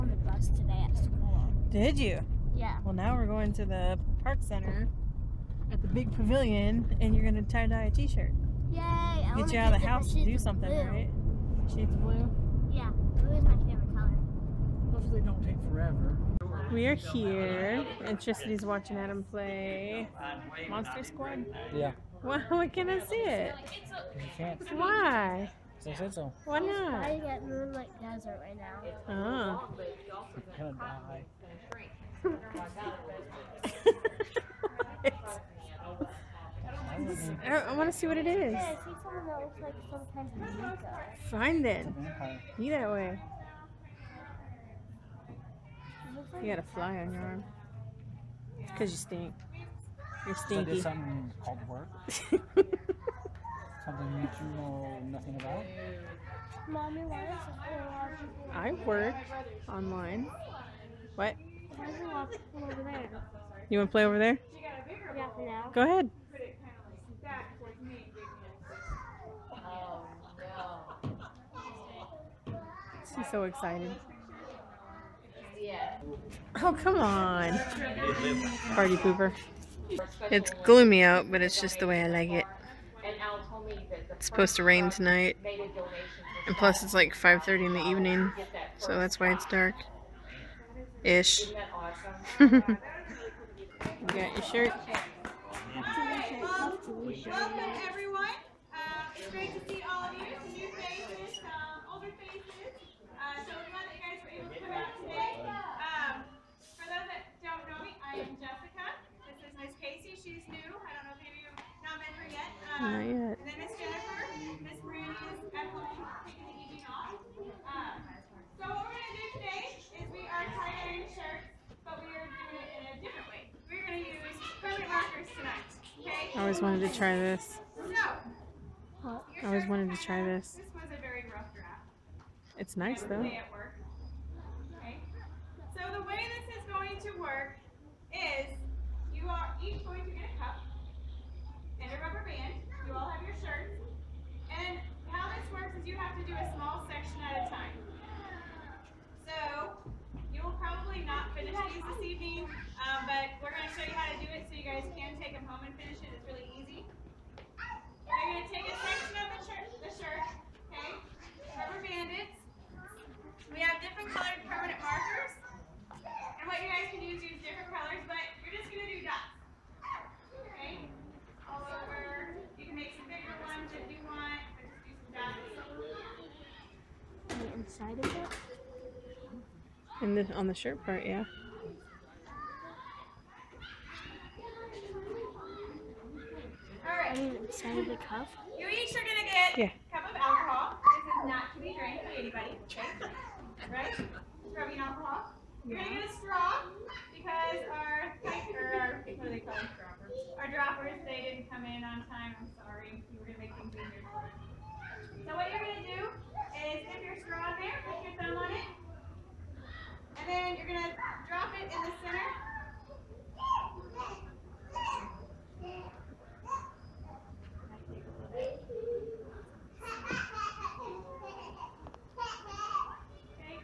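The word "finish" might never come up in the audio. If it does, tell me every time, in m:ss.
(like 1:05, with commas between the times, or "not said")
2:31, 2:35.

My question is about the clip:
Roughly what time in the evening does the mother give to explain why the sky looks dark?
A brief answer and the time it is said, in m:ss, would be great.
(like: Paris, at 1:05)
5:30, at 1:27.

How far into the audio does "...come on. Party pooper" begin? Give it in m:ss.
1:16.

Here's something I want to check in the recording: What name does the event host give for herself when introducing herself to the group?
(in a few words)
Jessica.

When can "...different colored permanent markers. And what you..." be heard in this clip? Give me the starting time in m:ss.
2:43.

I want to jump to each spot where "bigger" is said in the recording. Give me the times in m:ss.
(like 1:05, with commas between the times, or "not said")
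2:53.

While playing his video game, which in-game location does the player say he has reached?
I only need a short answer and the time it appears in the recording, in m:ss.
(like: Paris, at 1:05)
Moonlight Desert, at 0:27.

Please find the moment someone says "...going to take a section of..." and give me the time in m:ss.
2:38.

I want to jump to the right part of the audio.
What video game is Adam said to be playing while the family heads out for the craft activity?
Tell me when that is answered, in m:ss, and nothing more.
0:20.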